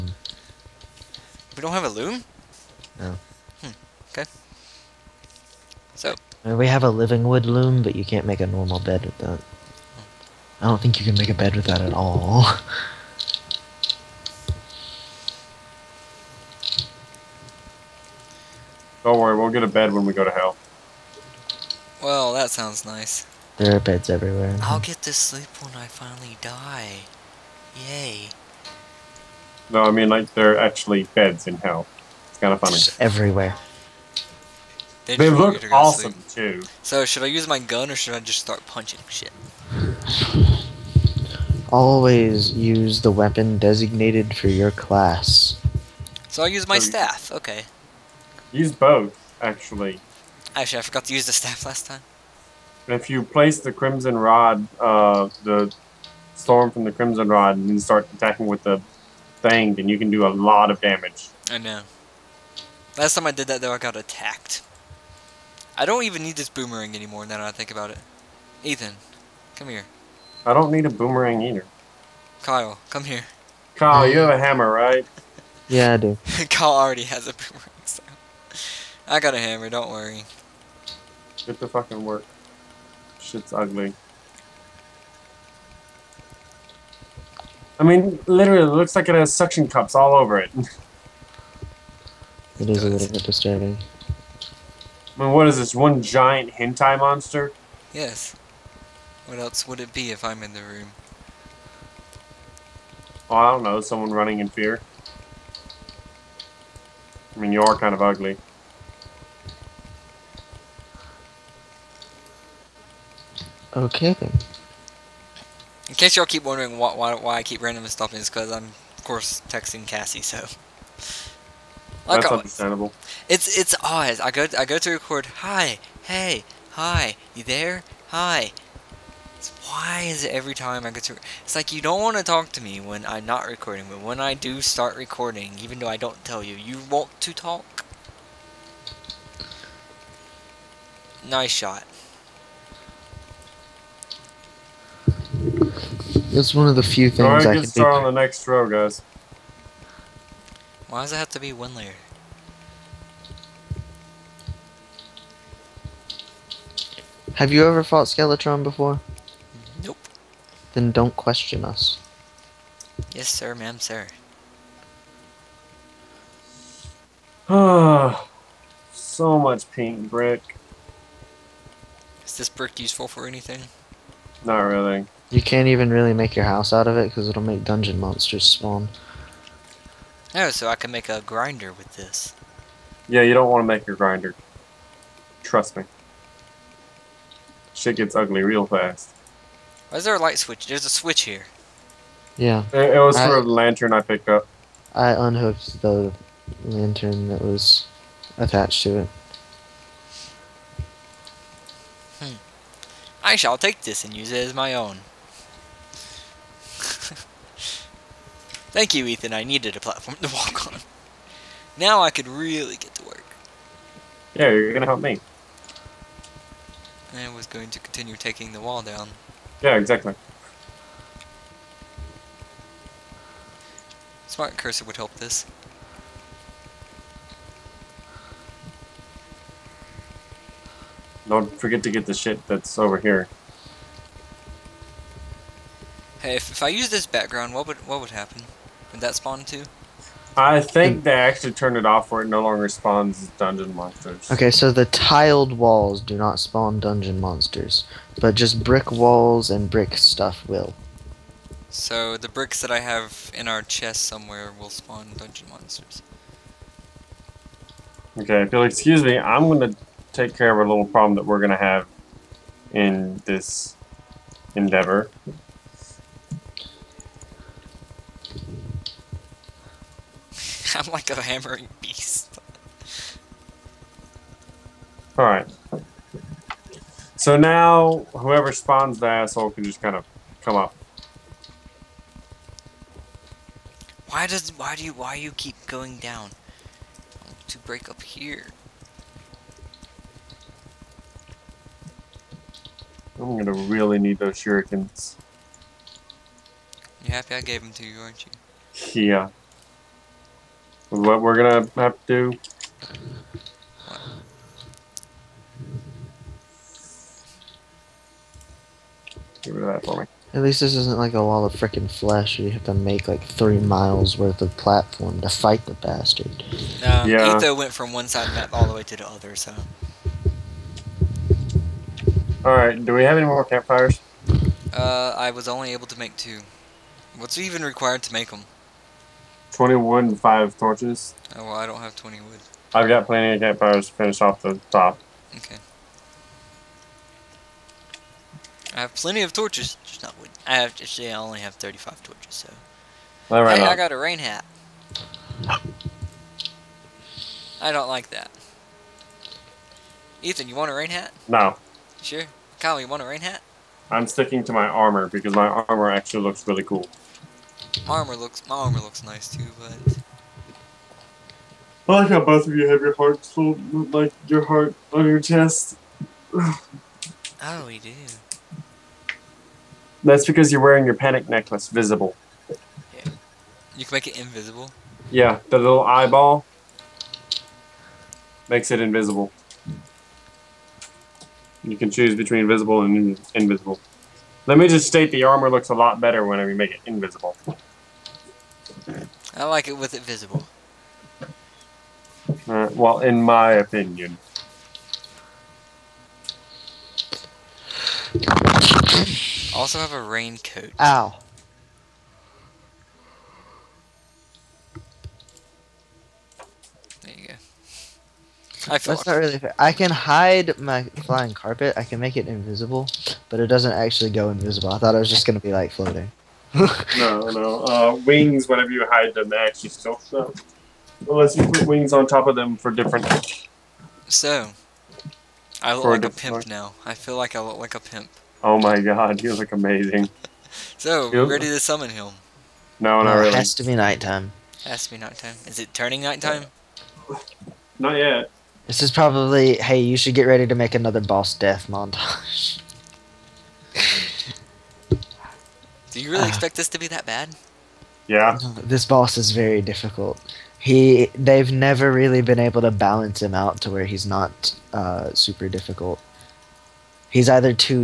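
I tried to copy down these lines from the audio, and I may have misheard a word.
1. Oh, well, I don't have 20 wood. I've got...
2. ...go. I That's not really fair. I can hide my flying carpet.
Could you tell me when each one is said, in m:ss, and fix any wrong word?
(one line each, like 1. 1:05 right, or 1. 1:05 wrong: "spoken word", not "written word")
1. 5:31 right
2. 6:47 right.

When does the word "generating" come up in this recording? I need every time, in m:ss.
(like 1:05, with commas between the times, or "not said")
not said.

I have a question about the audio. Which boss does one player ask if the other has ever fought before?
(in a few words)
Skeletron.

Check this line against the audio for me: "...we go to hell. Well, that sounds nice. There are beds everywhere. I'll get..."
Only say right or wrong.
right.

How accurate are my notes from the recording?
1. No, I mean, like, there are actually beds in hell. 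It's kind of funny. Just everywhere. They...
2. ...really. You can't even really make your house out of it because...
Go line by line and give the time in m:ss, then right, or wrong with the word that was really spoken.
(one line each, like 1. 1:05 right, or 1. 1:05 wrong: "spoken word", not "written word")
1. 0:29 right
2. 2:54 right.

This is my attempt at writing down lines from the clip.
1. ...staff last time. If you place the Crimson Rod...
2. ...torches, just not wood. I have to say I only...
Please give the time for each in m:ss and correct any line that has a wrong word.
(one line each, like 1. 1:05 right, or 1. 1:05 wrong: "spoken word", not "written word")
1. 0:51 right
2. 5:39 right.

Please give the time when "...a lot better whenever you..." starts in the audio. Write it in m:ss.
6:25.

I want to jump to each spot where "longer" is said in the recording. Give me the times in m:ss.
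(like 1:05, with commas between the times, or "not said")
4:02.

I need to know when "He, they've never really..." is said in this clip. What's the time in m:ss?
7:30.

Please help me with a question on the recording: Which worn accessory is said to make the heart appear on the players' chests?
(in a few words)
panic necklace.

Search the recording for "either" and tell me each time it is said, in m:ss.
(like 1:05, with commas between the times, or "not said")
1:11, 7:37.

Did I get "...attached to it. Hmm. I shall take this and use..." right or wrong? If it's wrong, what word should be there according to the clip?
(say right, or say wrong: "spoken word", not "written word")
right.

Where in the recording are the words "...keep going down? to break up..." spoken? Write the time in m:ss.
4:45.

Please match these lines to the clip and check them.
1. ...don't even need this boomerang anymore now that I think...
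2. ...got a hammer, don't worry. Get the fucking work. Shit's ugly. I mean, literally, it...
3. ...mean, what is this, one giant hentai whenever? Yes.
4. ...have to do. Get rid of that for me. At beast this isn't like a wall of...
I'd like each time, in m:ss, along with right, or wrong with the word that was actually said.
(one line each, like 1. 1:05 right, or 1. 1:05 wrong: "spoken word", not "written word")
1. 1:05 right
2. 1:19 right
3. 1:35 wrong: "monster", not "whenever"
4. 5:01 wrong: "least", not "beast".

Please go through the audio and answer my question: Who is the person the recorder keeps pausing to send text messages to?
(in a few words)
Cassie.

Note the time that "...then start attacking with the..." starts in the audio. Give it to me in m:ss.
0:57.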